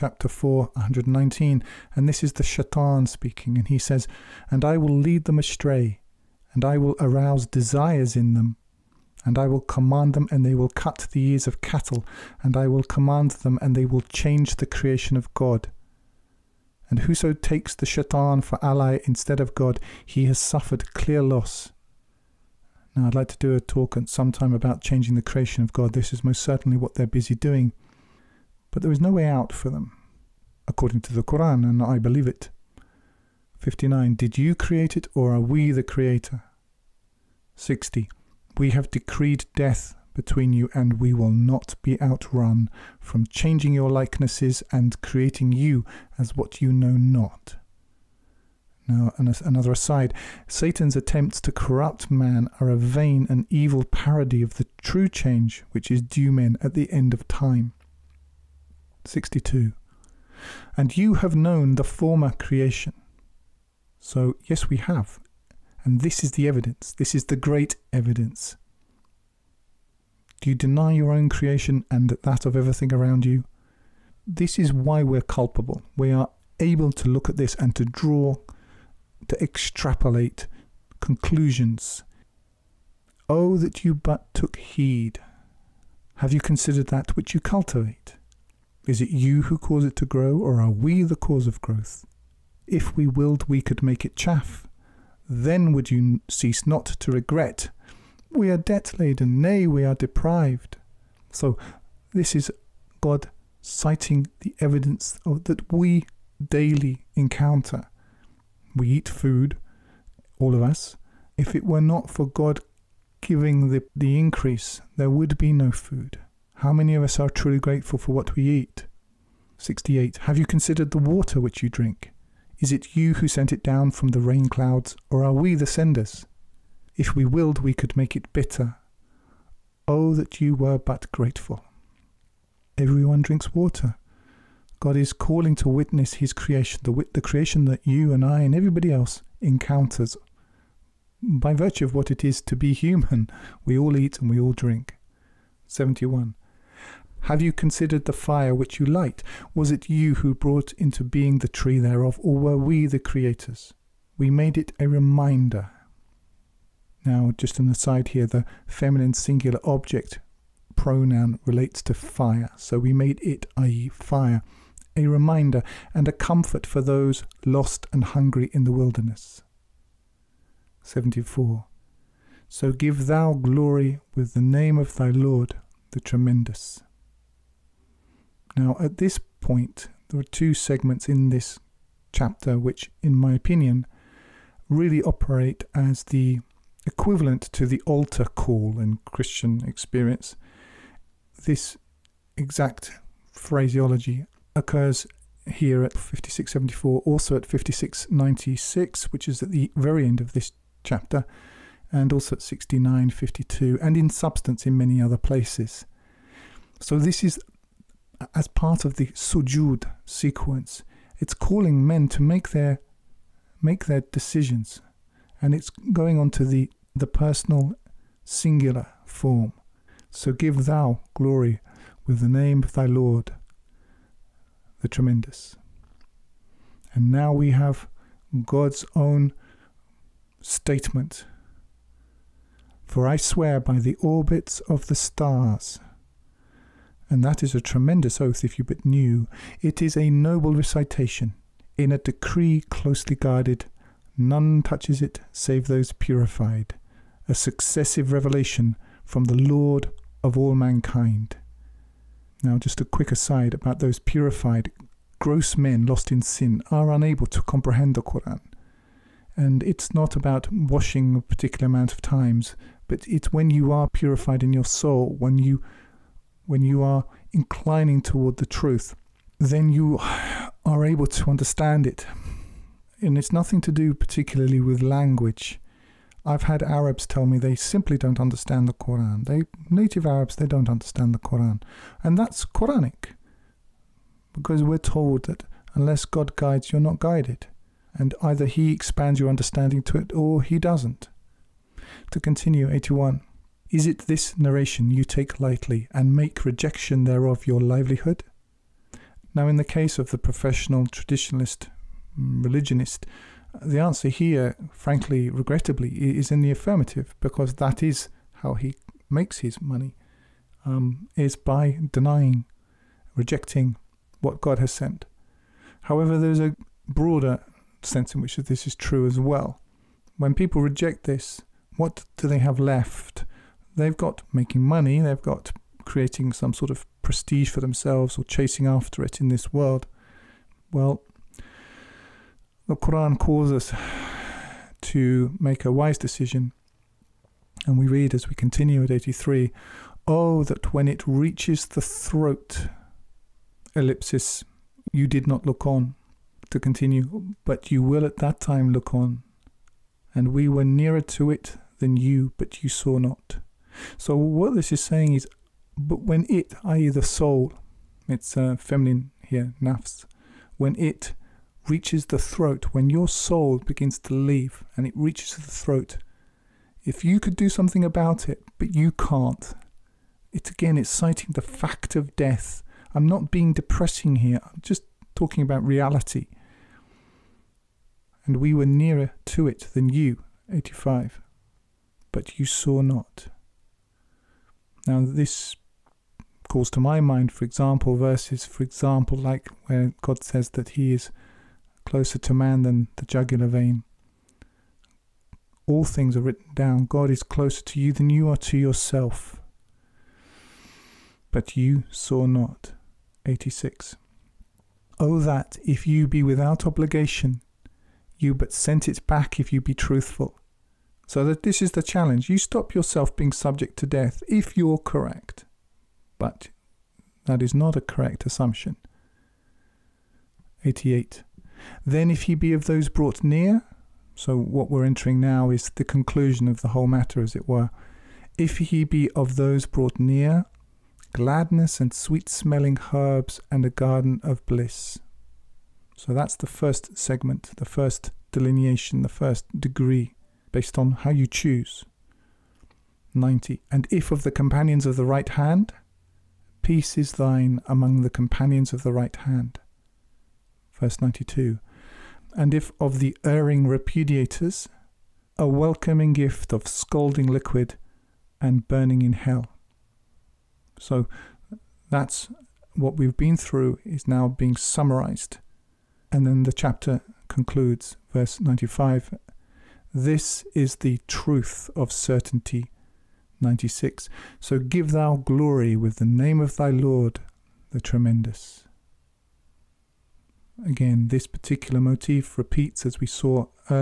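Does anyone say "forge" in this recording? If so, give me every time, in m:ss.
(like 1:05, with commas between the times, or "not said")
not said.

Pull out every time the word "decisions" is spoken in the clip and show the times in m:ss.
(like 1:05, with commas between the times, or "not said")
3:34, 5:35.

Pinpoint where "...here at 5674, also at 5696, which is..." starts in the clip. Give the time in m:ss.
3:15.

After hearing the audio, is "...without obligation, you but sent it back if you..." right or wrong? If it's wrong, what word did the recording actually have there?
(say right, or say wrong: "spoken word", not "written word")
right.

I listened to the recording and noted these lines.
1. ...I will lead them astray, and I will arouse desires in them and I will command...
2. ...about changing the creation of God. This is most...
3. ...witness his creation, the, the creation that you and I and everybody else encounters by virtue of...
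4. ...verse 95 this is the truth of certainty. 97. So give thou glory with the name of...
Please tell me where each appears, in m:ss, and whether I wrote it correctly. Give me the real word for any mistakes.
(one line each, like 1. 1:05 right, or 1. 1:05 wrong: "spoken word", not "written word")
1. 0:04 right
2. 0:24 right
3. 2:15 right
4. 7:48 wrong: "96", not "97".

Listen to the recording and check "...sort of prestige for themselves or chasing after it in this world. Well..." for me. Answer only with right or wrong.
right.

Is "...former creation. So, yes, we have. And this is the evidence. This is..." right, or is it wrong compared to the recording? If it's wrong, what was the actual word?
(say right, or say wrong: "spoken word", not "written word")
right.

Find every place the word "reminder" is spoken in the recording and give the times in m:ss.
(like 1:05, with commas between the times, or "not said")
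2:34, 2:45.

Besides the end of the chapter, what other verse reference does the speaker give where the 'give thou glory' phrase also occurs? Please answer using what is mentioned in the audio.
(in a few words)
69:52.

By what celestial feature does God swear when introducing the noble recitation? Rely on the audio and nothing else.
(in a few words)
orbits of the stars.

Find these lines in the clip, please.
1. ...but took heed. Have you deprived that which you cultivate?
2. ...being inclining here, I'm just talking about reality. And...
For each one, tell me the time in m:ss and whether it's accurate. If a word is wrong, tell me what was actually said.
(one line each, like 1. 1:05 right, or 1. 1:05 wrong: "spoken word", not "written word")
1. 1:23 wrong: "considered", not "deprived"
2. 6:13 wrong: "depressing", not "inclining".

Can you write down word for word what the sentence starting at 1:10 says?
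Do you deny your own creation and that of everything around you?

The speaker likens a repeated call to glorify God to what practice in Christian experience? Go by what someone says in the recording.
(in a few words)
altar call.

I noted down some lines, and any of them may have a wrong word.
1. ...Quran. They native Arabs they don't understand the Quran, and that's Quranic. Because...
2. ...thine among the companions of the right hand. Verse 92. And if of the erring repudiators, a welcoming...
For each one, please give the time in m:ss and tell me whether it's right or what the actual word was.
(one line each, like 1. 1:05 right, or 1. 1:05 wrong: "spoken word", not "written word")
1. 4:38 right
2. 7:27 right.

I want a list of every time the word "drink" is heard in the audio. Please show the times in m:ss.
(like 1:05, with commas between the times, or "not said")
2:01, 2:13, 2:24.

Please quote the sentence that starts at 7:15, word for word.
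So that's the first segment, the first delineation, the first degree based on how you choose.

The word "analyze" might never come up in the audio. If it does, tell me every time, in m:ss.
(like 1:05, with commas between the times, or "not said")
not said.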